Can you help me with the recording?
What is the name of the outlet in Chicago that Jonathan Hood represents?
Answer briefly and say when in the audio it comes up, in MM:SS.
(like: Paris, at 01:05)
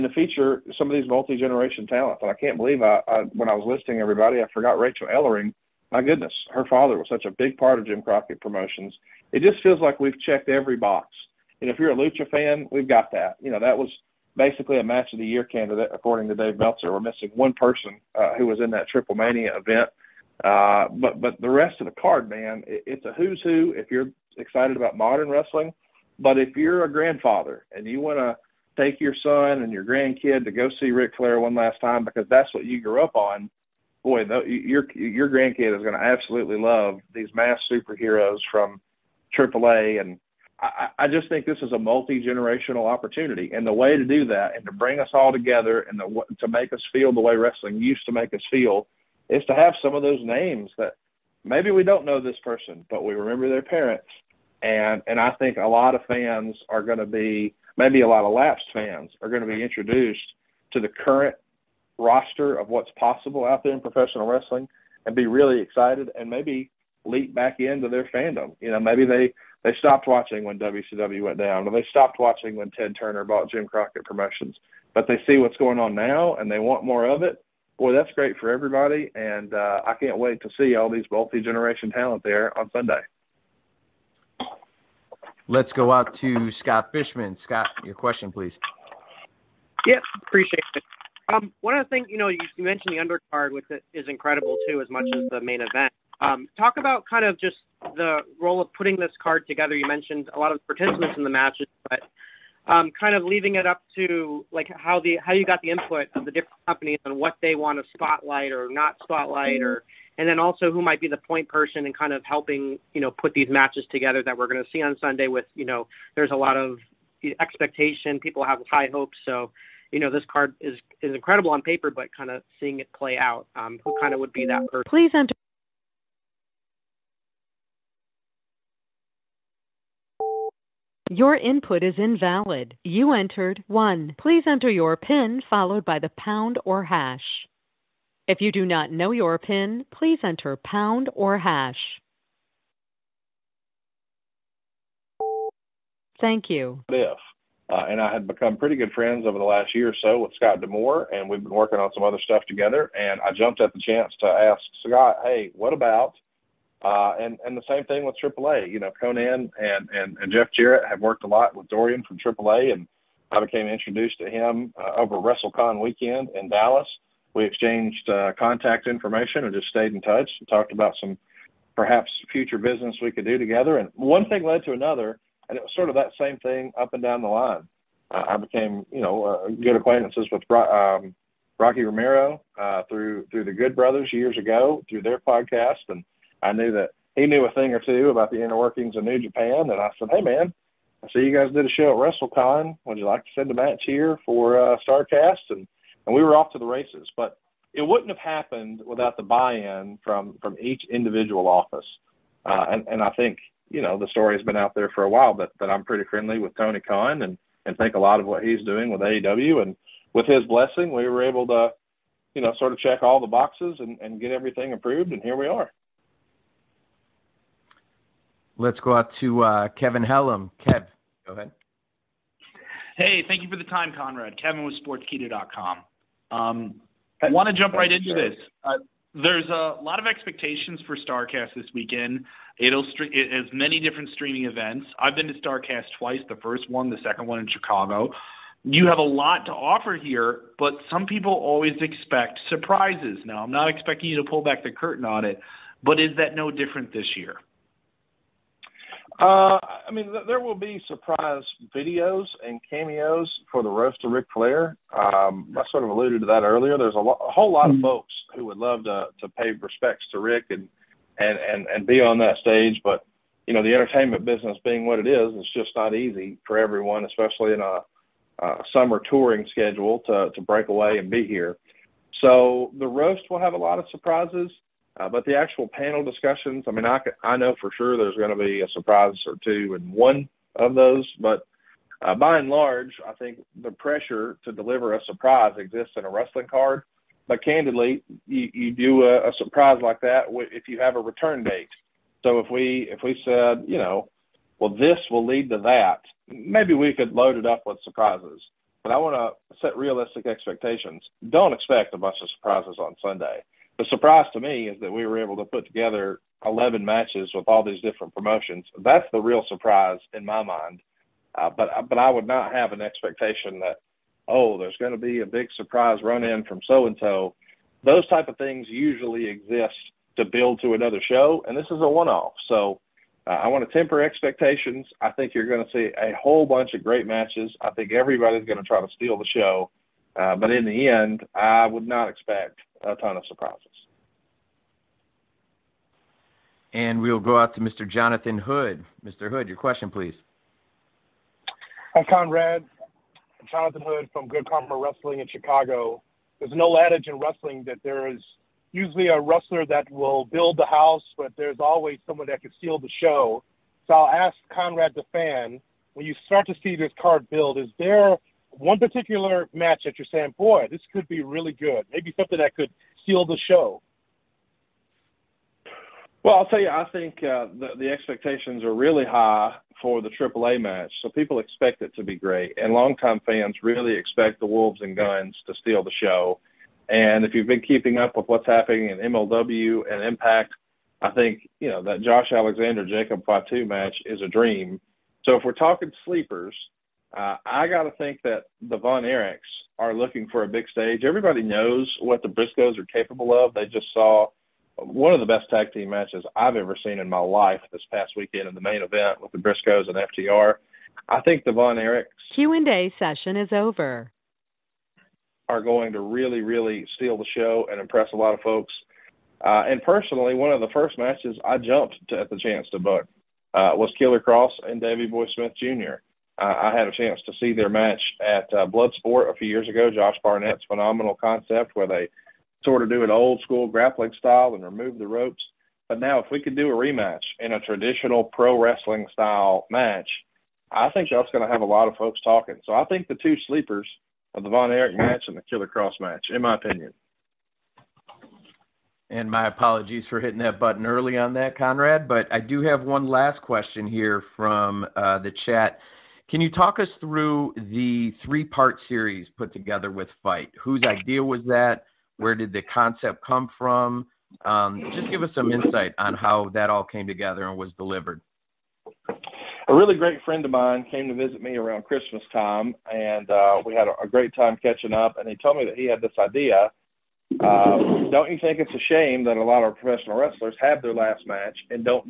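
Good Karma Wrestling, at 05:44.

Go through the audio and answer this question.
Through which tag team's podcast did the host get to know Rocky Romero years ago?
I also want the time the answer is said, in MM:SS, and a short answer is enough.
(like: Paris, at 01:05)
The Good Brothers, at 03:03.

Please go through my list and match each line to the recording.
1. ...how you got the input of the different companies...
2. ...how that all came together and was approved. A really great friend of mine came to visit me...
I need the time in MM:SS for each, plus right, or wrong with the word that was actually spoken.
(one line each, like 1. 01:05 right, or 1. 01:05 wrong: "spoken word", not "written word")
1. 01:45 right
2. 07:36 wrong: "delivered", not "approved".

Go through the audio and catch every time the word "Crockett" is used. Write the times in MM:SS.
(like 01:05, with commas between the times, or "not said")
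00:08, 01:13.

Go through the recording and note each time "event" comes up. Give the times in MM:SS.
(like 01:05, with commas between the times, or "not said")
00:19, 01:35, 03:54, 06:38.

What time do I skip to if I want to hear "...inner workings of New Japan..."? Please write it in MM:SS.
03:08.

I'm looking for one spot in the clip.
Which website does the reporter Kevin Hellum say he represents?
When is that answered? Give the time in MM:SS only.
03:44.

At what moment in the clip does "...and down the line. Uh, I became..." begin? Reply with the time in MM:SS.
02:56.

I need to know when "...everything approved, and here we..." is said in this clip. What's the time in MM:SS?
03:34.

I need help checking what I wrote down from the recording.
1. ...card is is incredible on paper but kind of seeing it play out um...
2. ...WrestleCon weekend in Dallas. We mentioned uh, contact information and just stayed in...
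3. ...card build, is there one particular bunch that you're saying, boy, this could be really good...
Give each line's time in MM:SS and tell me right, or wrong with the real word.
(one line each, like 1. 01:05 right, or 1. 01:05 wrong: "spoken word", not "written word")
1. 02:00 right
2. 02:45 wrong: "exchanged", not "mentioned"
3. 05:56 wrong: "match", not "bunch".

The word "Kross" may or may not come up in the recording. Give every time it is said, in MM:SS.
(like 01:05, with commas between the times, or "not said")
06:54, 07:15.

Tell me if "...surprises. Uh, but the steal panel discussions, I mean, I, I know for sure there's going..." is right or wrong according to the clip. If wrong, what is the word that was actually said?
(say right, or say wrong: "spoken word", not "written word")
wrong: "actual", not "steal".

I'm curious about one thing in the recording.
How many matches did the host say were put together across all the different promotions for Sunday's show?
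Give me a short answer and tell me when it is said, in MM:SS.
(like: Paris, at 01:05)
11, at 05:06.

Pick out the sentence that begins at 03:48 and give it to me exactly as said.
Uh, there's a lot of expectations for StarCast this weekend.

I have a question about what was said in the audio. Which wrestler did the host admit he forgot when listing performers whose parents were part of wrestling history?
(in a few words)
Rachel Ellering.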